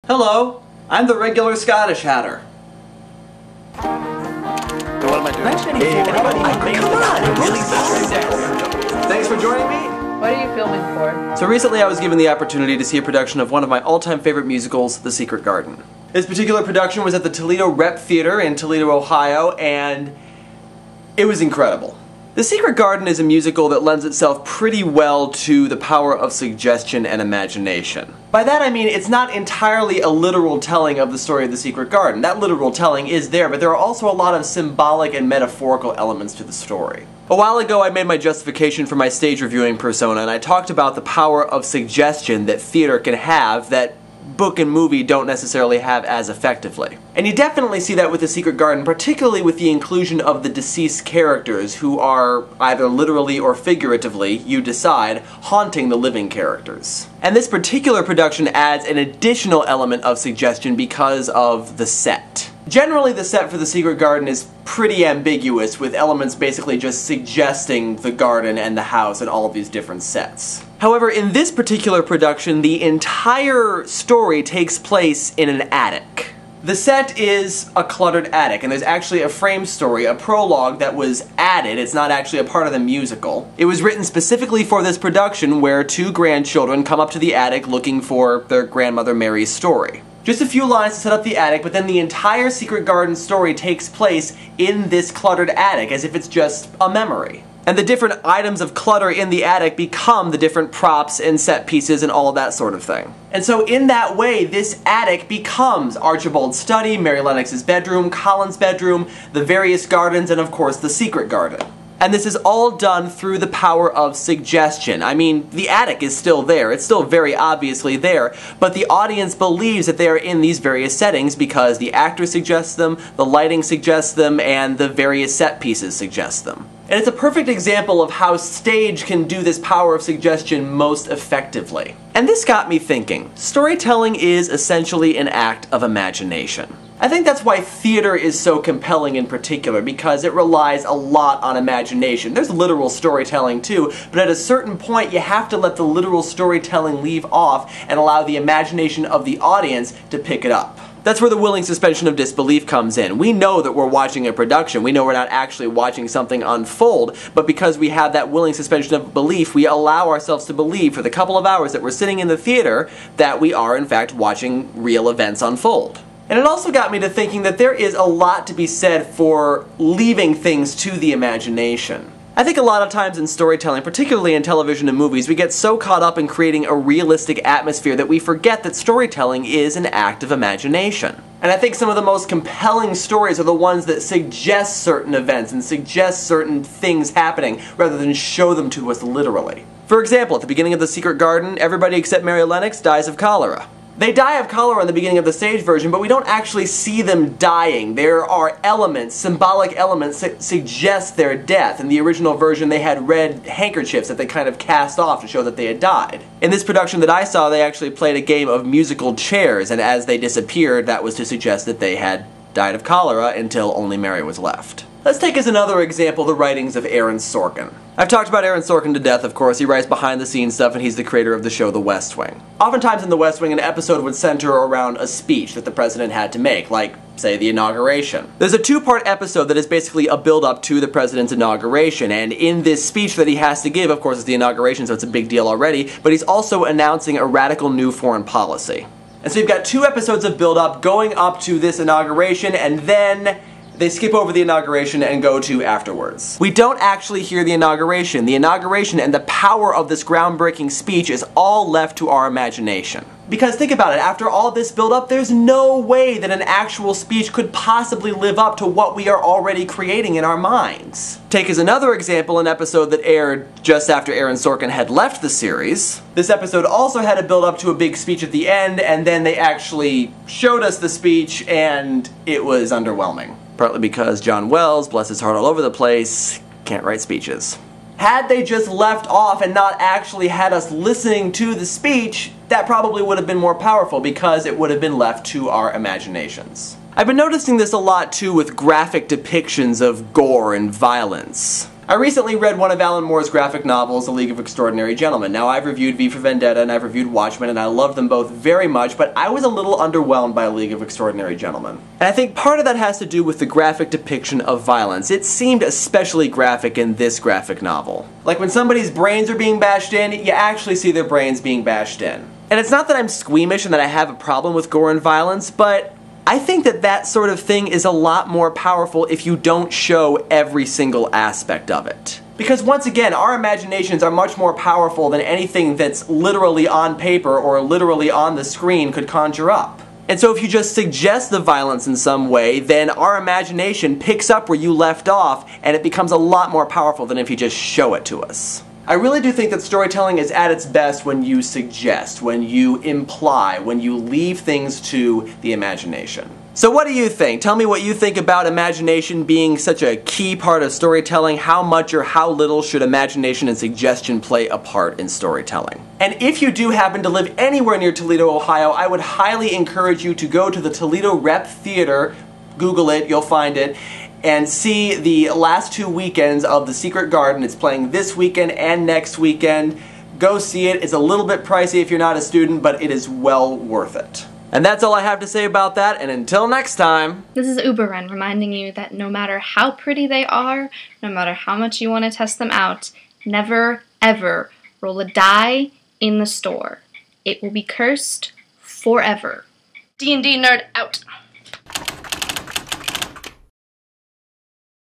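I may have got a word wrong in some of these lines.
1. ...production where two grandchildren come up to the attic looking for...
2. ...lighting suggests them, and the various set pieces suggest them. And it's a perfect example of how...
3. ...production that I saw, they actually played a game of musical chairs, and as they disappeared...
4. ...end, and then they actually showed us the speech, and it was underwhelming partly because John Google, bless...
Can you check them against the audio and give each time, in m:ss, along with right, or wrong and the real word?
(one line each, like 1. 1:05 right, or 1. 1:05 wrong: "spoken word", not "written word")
1. 1:24 right
2. 2:03 right
3. 3:26 right
4. 4:28 wrong: "Wells", not "Google".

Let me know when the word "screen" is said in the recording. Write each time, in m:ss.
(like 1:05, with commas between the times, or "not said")
5:28.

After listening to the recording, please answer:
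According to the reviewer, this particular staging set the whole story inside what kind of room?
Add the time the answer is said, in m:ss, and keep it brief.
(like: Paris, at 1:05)
An attic, at 1:15.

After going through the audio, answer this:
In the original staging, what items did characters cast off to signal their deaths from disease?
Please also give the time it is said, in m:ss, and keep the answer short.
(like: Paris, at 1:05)
Red handkerchiefs, at 3:23.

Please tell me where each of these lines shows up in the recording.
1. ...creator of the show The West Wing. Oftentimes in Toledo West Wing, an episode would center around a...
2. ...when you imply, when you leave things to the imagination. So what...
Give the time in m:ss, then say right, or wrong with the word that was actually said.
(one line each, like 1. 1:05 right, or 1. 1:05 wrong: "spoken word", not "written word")
1. 3:41 wrong: "The", not "Toledo"
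2. 5:42 right.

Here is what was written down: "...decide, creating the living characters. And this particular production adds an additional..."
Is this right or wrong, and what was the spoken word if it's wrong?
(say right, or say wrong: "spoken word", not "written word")
wrong: "haunting", not "creating".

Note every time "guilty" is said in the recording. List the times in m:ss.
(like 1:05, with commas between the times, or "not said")
not said.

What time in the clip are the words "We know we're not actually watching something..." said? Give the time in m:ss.
2:34.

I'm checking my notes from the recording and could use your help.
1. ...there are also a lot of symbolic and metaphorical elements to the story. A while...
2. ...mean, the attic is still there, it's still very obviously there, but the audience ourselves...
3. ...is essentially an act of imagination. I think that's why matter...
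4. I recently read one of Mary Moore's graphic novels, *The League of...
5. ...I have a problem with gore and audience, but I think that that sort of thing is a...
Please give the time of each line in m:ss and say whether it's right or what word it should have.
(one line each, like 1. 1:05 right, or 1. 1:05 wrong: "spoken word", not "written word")
1. 0:33 right
2. 1:55 wrong: "believes", not "ourselves"
3. 2:14 wrong: "theater", not "matter"
4. 4:51 wrong: "Alan", not "Mary"
5. 5:13 wrong: "violence", not "audience".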